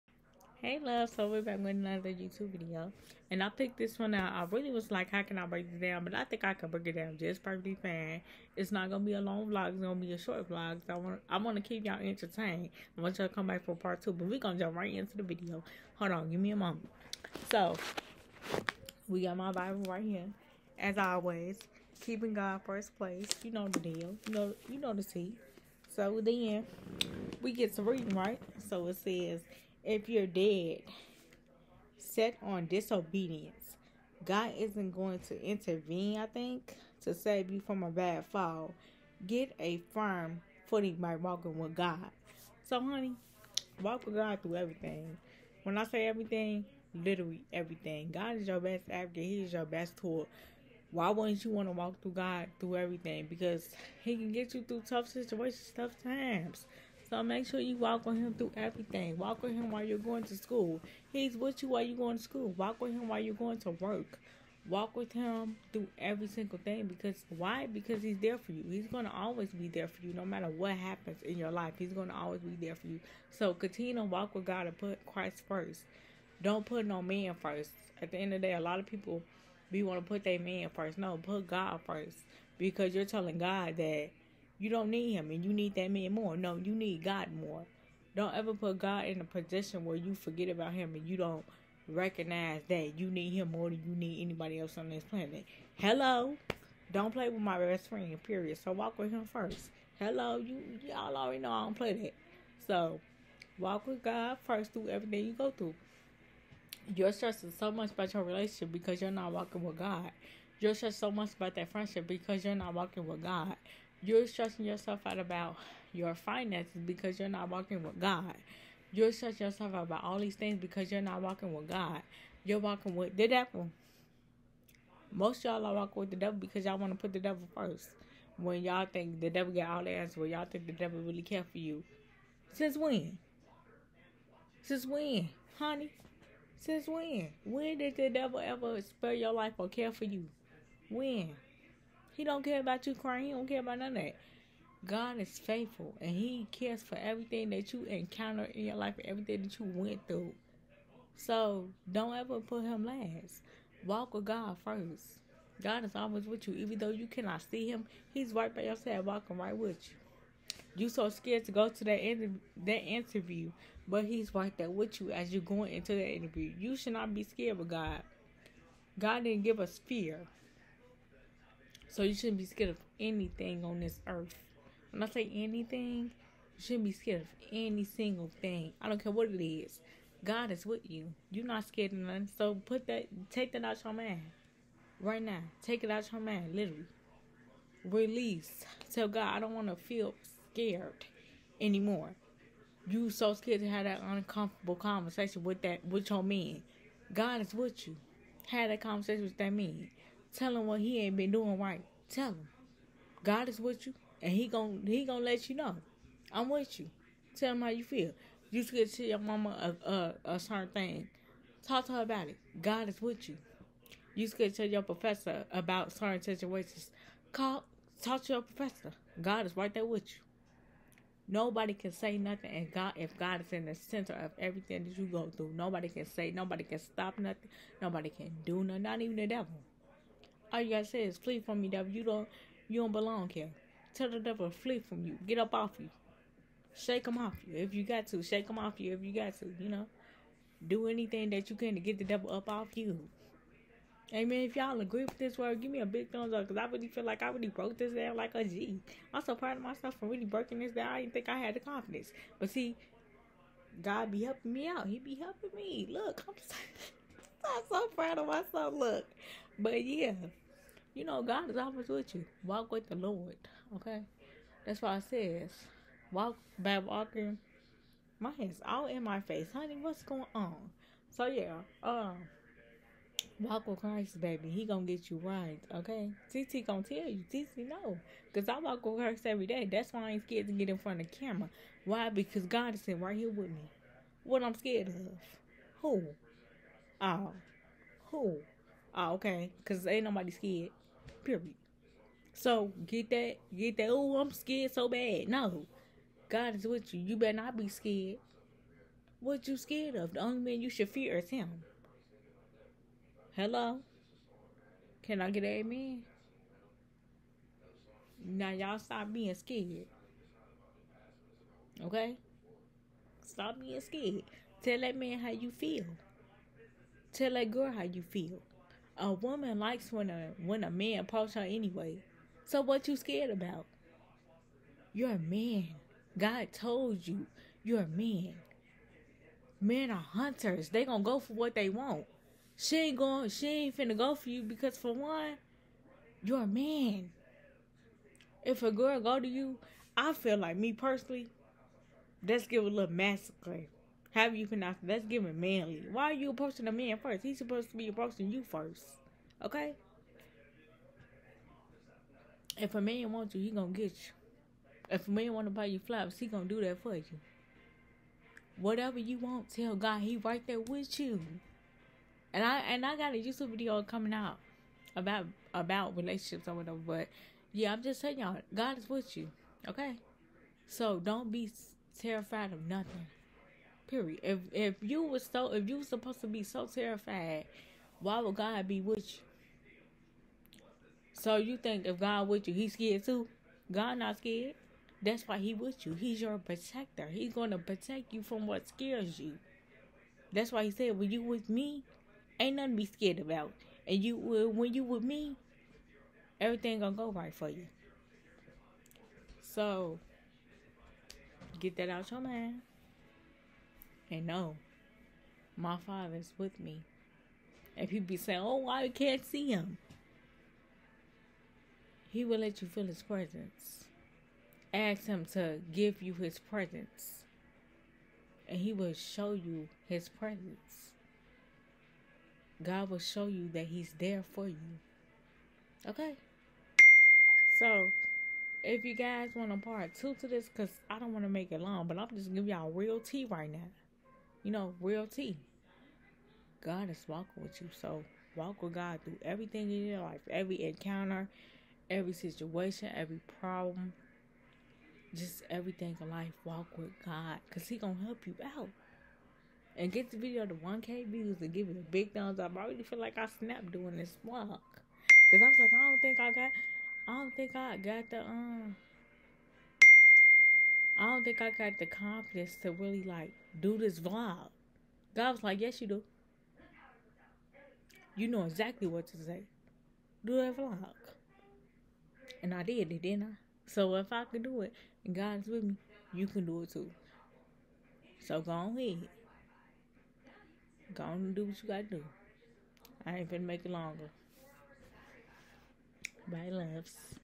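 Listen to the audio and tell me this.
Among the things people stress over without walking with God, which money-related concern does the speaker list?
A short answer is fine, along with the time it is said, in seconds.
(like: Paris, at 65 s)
Finances, at 116 s.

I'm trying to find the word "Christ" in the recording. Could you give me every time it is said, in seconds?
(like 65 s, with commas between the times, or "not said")
75 s, 273 s, 278 s.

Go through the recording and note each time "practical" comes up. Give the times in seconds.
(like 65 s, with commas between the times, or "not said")
not said.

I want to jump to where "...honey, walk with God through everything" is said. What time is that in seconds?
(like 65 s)
42 s.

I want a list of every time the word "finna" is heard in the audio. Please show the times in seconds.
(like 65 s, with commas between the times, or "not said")
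333 s, 483 s.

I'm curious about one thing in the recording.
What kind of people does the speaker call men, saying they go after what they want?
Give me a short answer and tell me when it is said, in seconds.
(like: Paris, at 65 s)
Hunters, at 330 s.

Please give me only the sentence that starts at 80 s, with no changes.
No, put God first because you're telling God that you don't need him and you need that man more.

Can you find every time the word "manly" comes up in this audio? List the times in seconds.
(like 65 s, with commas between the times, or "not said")
345 s.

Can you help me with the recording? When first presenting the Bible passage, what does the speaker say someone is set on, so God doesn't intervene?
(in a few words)
Disobedience.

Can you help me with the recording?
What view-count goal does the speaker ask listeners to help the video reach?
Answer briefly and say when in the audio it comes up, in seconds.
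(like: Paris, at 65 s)
1K views, at 450 s.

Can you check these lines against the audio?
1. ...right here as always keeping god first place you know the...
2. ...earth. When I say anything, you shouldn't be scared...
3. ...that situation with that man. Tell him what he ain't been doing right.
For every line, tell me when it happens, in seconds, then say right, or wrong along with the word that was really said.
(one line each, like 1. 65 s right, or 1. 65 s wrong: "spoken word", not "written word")
1. 19 s right
2. 174 s right
3. 198 s wrong: "conversation", not "situation".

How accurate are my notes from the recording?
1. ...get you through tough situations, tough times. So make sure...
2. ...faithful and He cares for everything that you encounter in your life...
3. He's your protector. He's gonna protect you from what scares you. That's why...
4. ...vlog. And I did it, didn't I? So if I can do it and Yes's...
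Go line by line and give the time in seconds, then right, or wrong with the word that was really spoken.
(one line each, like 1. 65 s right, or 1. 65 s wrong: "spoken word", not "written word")
1. 54 s right
2. 145 s right
3. 385 s right
4. 470 s wrong: "God", not "Yes".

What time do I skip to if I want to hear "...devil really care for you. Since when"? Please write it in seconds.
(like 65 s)
130 s.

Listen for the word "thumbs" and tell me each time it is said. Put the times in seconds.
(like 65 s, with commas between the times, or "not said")
246 s, 452 s.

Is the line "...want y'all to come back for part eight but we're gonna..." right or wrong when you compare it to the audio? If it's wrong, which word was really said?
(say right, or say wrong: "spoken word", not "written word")
wrong: "two", not "eight".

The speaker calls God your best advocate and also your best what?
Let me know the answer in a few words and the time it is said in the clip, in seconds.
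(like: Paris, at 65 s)
Tool, at 49 s.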